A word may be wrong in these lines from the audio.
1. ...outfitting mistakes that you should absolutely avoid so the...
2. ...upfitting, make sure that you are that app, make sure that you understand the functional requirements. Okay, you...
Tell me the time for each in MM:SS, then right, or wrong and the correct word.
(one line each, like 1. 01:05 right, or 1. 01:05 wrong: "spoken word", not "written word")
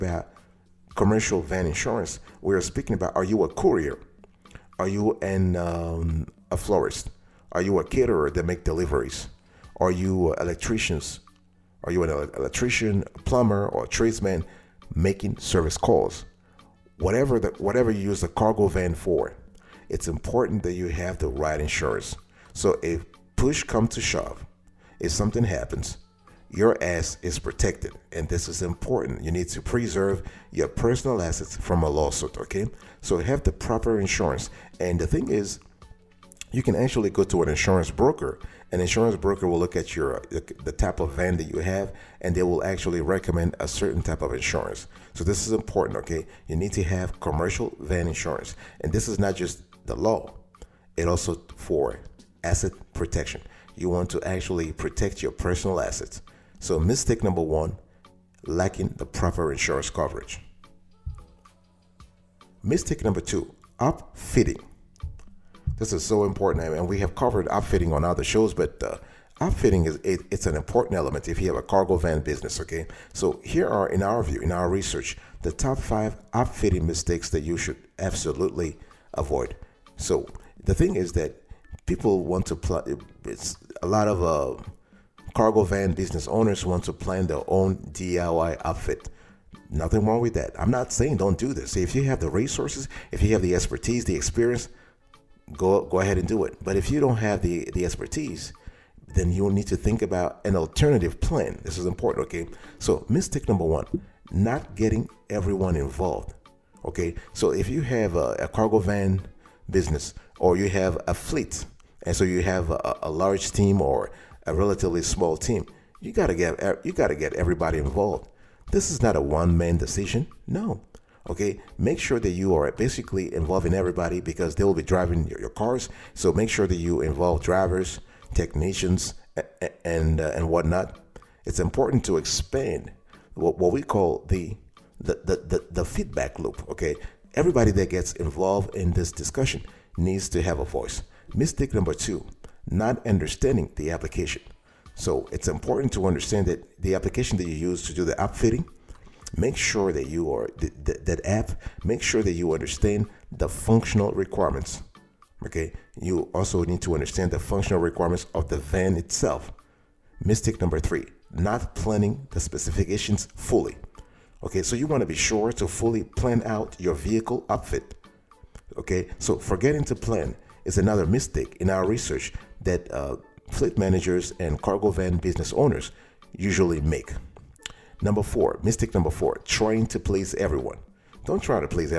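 1. 01:16 right
2. 02:28 right.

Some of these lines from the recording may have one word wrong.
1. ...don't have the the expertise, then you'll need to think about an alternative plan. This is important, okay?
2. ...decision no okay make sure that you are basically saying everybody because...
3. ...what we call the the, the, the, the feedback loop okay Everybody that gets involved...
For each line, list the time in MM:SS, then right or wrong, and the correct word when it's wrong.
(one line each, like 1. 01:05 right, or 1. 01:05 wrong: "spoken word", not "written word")
1. 01:36 right
2. 01:59 wrong: "involving", not "saying"
3. 02:13 right.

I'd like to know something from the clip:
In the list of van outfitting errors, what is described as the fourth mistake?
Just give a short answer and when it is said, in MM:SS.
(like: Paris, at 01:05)
Trying to please everyone, at 02:59.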